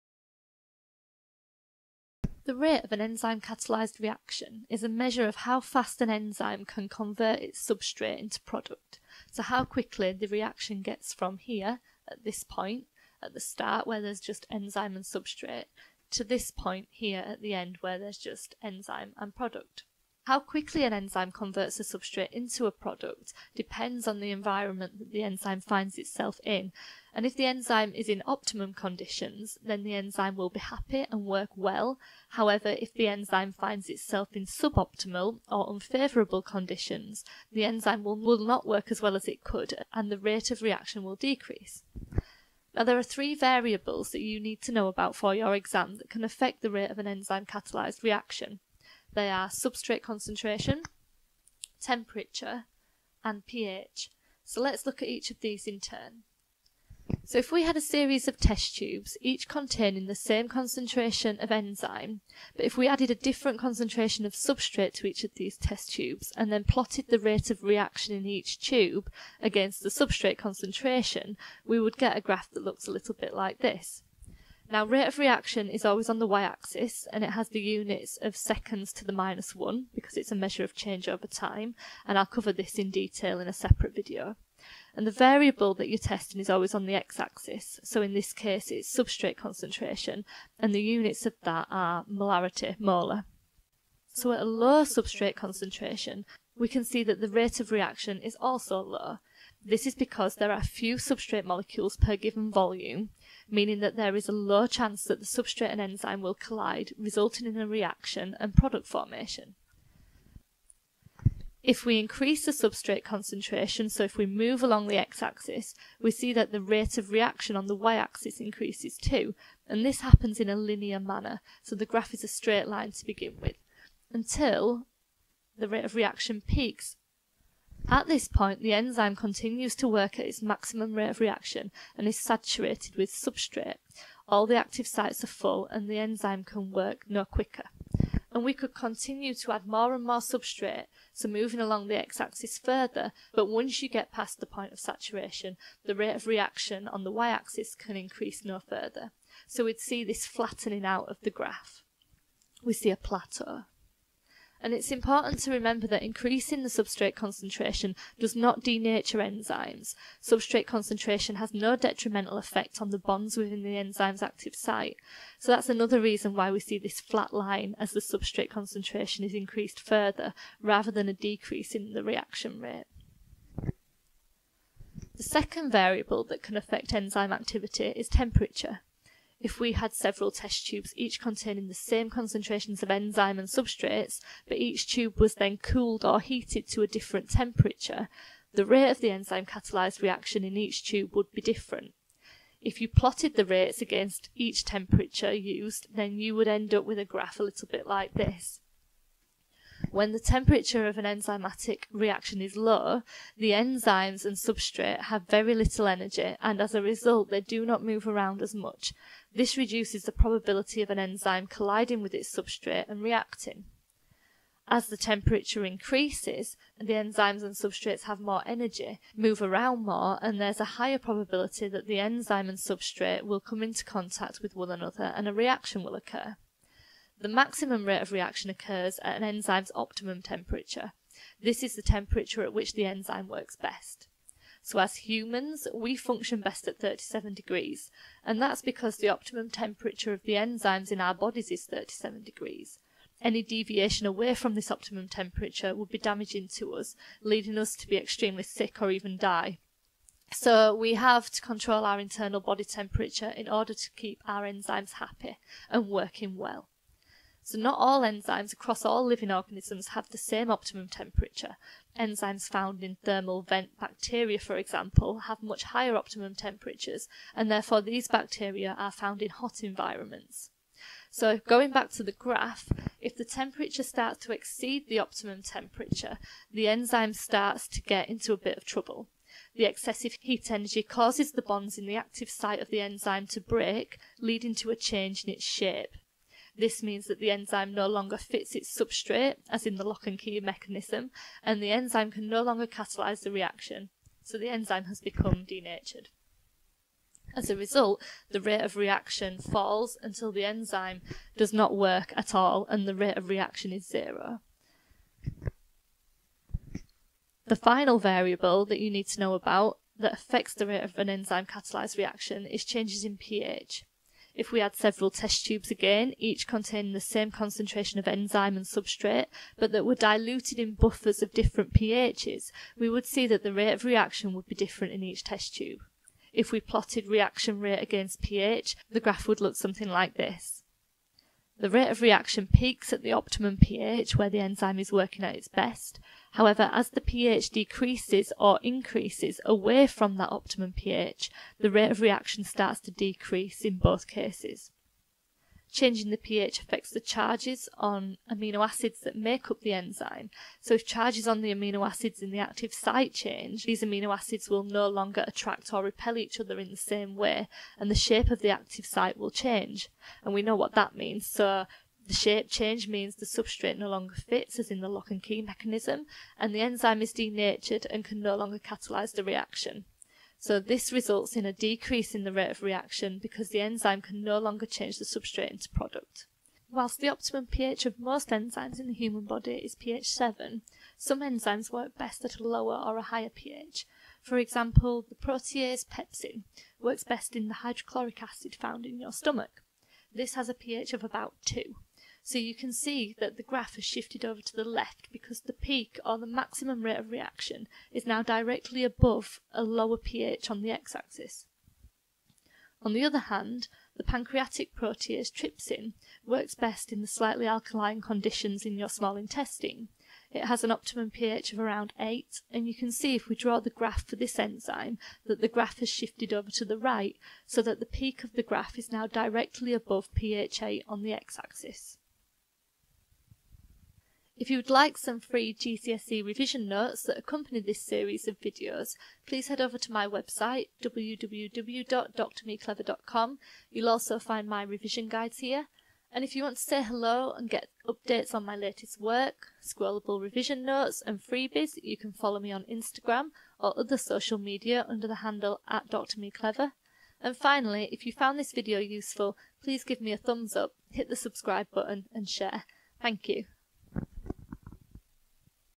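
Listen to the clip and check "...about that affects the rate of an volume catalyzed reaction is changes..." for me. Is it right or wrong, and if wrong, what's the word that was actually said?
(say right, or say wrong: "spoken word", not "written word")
wrong: "enzyme", not "volume".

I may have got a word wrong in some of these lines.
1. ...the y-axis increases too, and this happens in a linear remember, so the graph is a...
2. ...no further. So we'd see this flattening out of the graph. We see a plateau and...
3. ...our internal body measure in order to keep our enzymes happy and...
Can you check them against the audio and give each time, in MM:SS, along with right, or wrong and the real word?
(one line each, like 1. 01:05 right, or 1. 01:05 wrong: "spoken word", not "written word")
1. 01:57 wrong: "manner", not "remember"
2. 02:28 right
3. 04:11 wrong: "temperature", not "measure".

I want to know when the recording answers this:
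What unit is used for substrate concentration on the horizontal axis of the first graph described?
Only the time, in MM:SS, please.
01:32.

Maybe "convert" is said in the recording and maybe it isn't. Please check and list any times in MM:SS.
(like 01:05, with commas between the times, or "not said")
00:06, 00:21.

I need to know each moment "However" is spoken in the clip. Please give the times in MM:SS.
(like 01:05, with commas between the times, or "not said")
00:32, 05:36.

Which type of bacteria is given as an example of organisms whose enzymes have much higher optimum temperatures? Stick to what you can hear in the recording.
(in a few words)
thermal vent bacteria.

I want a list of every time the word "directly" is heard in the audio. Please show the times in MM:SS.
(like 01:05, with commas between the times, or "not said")
06:38, 06:59.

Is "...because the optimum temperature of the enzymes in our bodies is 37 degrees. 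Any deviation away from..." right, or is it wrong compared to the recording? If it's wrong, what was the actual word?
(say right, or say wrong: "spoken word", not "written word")
right.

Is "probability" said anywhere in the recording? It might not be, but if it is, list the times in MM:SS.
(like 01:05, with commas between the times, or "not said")
03:30, 03:40.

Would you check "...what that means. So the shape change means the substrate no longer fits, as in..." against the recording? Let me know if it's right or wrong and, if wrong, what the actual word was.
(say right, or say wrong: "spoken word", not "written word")
right.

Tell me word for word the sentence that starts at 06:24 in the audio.
For example, the protease pepsin works best in the hydrochloric acid found in your stomach.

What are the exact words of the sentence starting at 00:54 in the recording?
So let's look at each of these in turn.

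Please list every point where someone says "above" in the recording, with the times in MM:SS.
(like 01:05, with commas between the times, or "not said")
06:38, 06:59.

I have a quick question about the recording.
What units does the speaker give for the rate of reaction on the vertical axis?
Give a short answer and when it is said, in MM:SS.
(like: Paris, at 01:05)
seconds to the minus 1, at 01:18.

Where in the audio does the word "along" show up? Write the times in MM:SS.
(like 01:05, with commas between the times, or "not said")
01:54, 02:21.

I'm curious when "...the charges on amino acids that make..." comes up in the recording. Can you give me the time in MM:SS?
05:46.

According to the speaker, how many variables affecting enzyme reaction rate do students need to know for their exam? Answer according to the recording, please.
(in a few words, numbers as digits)
3.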